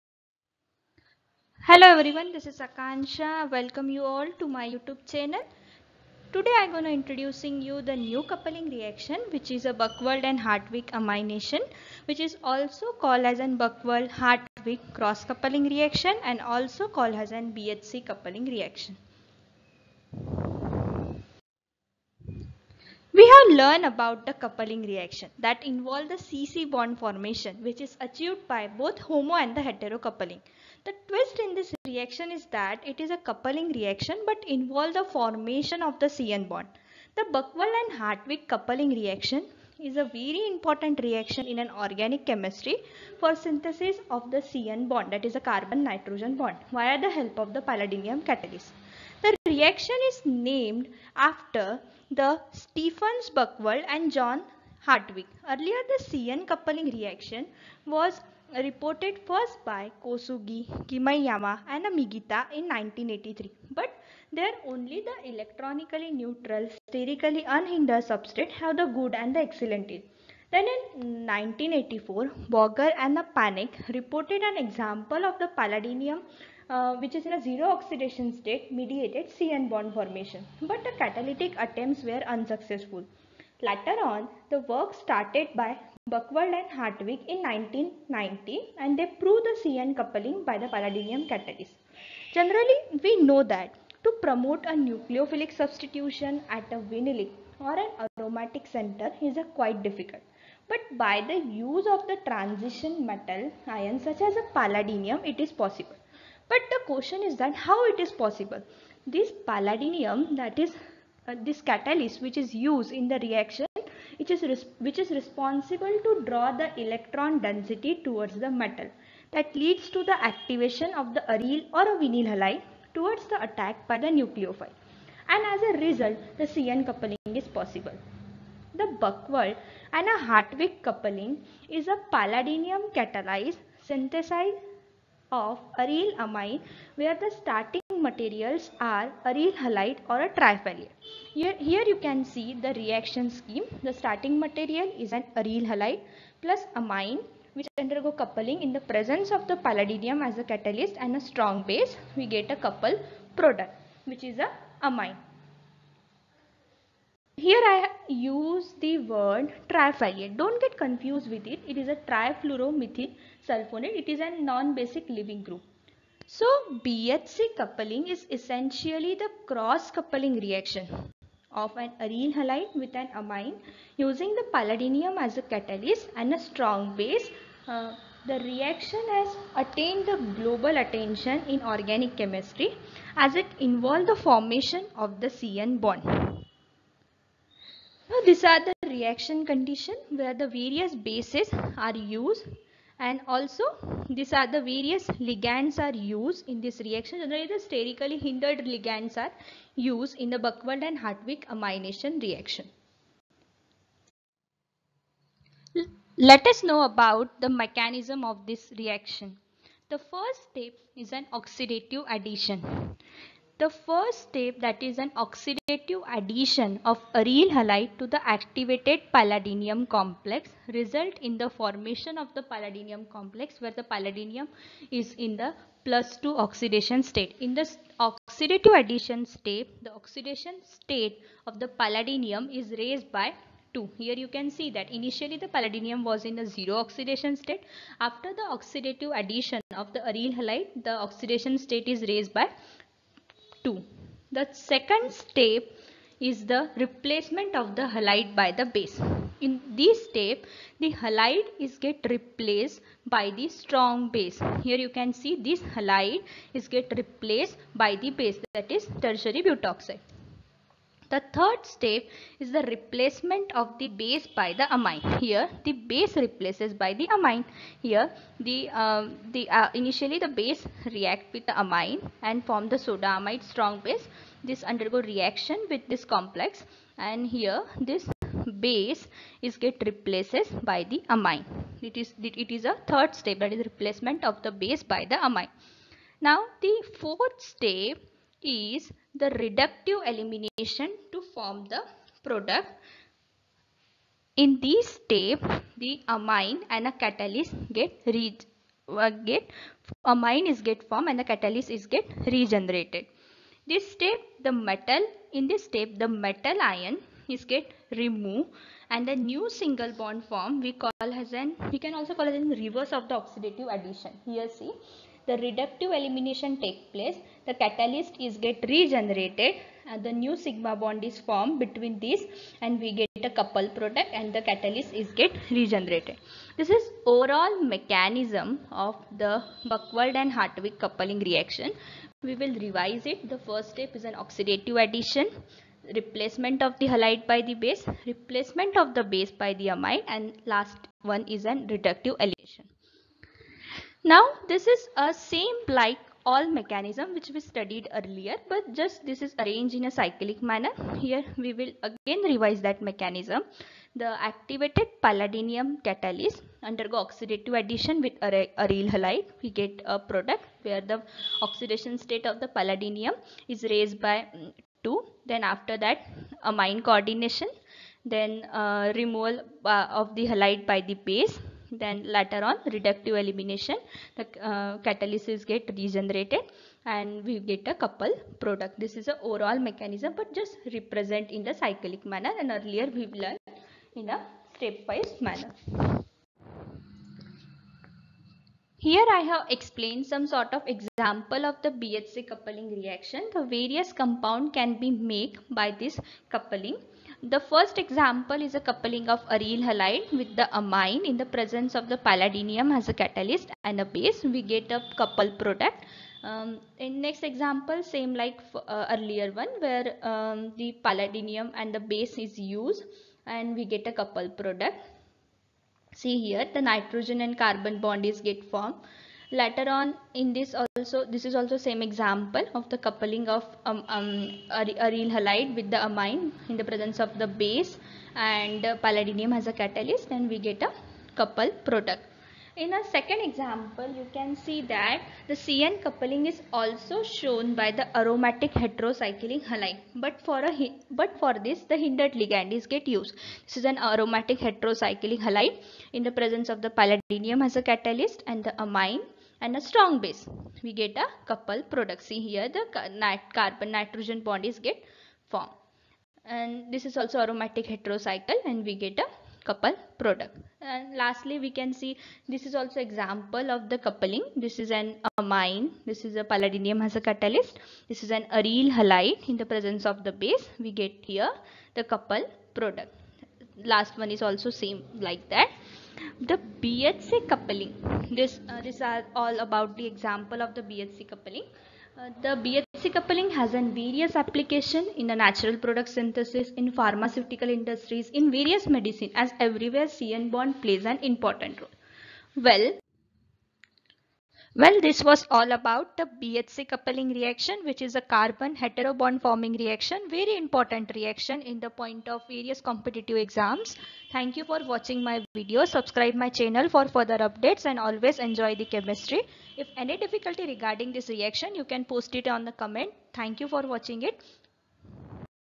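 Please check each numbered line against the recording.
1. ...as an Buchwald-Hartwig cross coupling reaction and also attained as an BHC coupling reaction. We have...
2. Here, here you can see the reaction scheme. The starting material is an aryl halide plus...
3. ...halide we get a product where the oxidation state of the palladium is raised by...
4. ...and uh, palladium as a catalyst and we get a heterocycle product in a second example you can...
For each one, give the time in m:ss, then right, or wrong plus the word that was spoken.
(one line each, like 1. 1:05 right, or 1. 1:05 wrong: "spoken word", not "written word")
1. 0:13 wrong: "called", not "attained"
2. 2:21 right
3. 5:58 right
4. 7:08 wrong: "couple", not "heterocycle".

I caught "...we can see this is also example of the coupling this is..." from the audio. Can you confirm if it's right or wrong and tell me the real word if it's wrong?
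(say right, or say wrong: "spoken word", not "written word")
right.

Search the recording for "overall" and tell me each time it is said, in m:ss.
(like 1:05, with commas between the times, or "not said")
5:27, 6:19.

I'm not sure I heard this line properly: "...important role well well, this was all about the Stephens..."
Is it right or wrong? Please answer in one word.
wrong.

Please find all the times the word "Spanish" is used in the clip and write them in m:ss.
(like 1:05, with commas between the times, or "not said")
not said.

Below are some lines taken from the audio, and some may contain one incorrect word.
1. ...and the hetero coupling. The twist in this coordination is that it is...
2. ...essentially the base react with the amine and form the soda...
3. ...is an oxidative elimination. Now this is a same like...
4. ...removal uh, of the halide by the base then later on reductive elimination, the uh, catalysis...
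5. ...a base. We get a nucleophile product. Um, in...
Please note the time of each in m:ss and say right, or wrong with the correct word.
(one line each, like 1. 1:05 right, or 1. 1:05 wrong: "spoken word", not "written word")
1. 0:29 wrong: "reaction", not "coordination"
2. 4:29 wrong: "initially", not "essentially"
3. 5:41 wrong: "reductive", not "oxidative"
4. 6:08 right
5. 6:43 wrong: "couple", not "nucleophile".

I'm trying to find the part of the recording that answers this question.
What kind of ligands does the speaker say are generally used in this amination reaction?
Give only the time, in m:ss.
3:17.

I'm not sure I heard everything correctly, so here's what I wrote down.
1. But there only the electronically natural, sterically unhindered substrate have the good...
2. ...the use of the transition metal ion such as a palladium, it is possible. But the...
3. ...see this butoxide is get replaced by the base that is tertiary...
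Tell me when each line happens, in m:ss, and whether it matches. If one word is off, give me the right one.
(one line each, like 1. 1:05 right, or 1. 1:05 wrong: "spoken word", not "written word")
1. 1:03 wrong: "neutral", not "natural"
2. 1:41 right
3. 4:15 wrong: "halide", not "butoxide".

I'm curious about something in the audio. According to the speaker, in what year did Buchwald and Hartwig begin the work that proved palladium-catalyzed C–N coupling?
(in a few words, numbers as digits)
1990.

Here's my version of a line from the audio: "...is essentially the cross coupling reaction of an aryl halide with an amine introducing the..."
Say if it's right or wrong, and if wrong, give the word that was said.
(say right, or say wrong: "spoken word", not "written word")
wrong: "using", not "introducing".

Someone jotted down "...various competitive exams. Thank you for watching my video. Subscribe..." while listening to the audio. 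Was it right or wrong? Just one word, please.
right.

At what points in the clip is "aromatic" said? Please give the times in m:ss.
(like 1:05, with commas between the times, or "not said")
1:38, 7:17, 7:23, 7:37.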